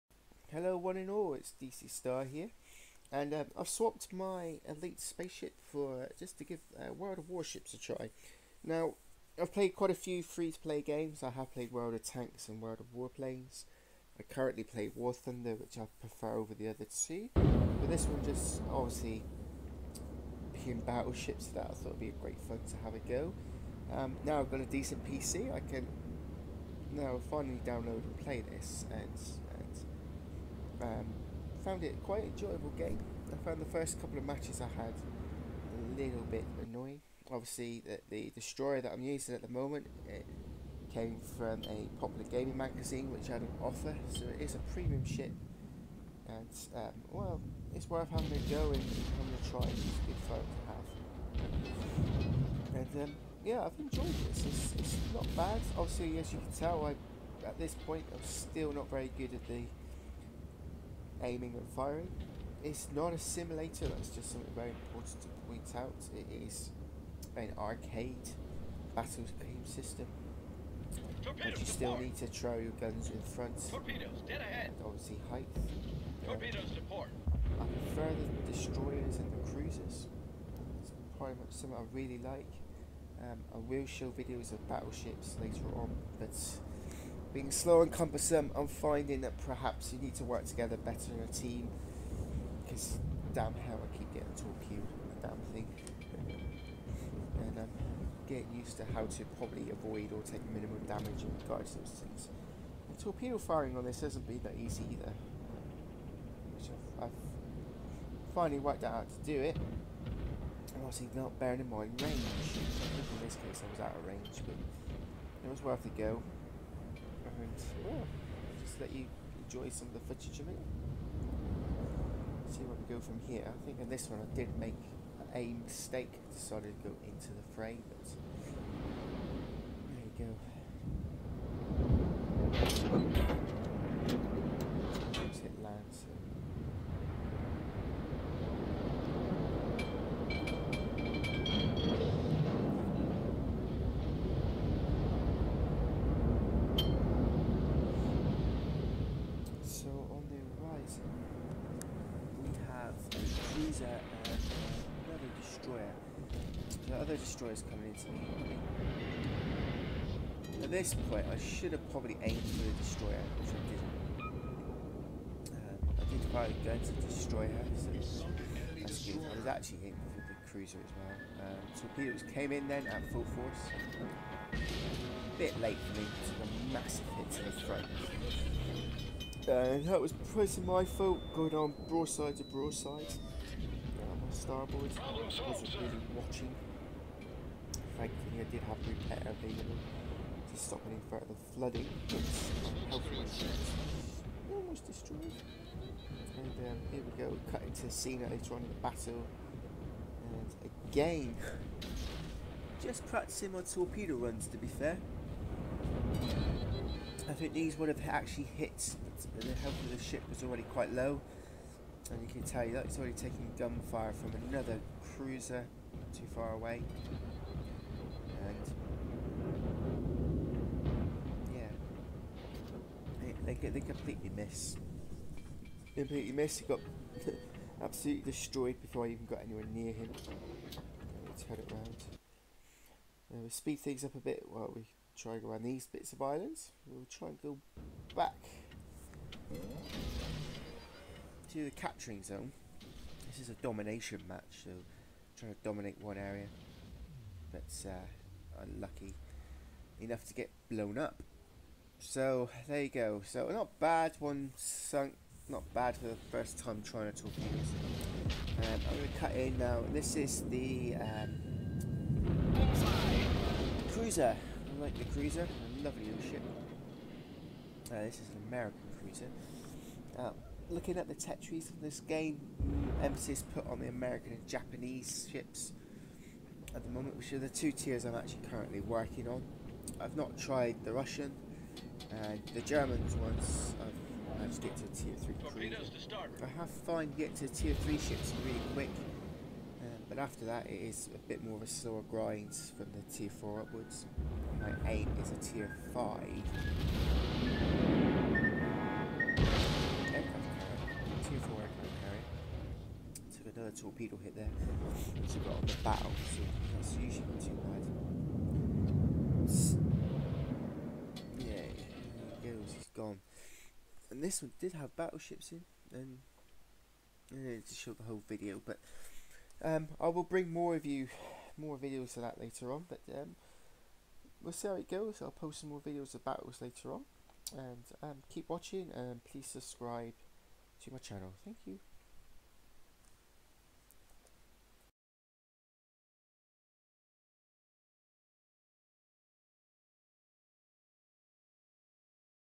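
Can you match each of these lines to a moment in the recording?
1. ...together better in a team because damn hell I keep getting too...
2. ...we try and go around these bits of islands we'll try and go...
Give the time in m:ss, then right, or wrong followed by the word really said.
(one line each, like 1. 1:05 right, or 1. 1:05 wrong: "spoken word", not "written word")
1. 1:30 right
2. 3:54 right.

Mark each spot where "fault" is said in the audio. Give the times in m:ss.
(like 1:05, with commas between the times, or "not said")
3:00.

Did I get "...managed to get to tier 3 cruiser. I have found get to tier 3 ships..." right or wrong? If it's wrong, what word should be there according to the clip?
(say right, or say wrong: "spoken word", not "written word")
right.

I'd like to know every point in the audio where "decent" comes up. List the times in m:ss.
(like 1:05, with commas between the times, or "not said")
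0:24.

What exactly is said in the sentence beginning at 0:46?
And um, well, it's worth having a go and having a try.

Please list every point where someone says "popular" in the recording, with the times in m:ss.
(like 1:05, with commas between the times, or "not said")
0:42.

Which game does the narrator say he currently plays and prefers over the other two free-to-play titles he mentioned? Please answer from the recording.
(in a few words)
War Thunder.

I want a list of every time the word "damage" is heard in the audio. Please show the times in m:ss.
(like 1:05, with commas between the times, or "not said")
1:40.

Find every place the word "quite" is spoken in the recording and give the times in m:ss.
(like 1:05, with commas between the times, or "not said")
0:09, 0:32, 3:30.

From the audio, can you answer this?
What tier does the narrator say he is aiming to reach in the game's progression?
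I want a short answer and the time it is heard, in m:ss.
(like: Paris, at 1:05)
Tier 5, at 4:55.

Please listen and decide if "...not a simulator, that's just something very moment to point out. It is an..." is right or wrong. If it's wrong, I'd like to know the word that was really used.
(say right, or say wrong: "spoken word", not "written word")
wrong: "important", not "moment".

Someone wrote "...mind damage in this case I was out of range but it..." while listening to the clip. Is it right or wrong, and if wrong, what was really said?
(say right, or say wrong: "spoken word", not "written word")
wrong: "range", not "damage".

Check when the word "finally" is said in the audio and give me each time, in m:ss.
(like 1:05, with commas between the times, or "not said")
0:27, 1:48.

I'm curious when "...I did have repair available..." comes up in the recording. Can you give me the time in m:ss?
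3:08.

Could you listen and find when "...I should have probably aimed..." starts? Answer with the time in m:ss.
2:41.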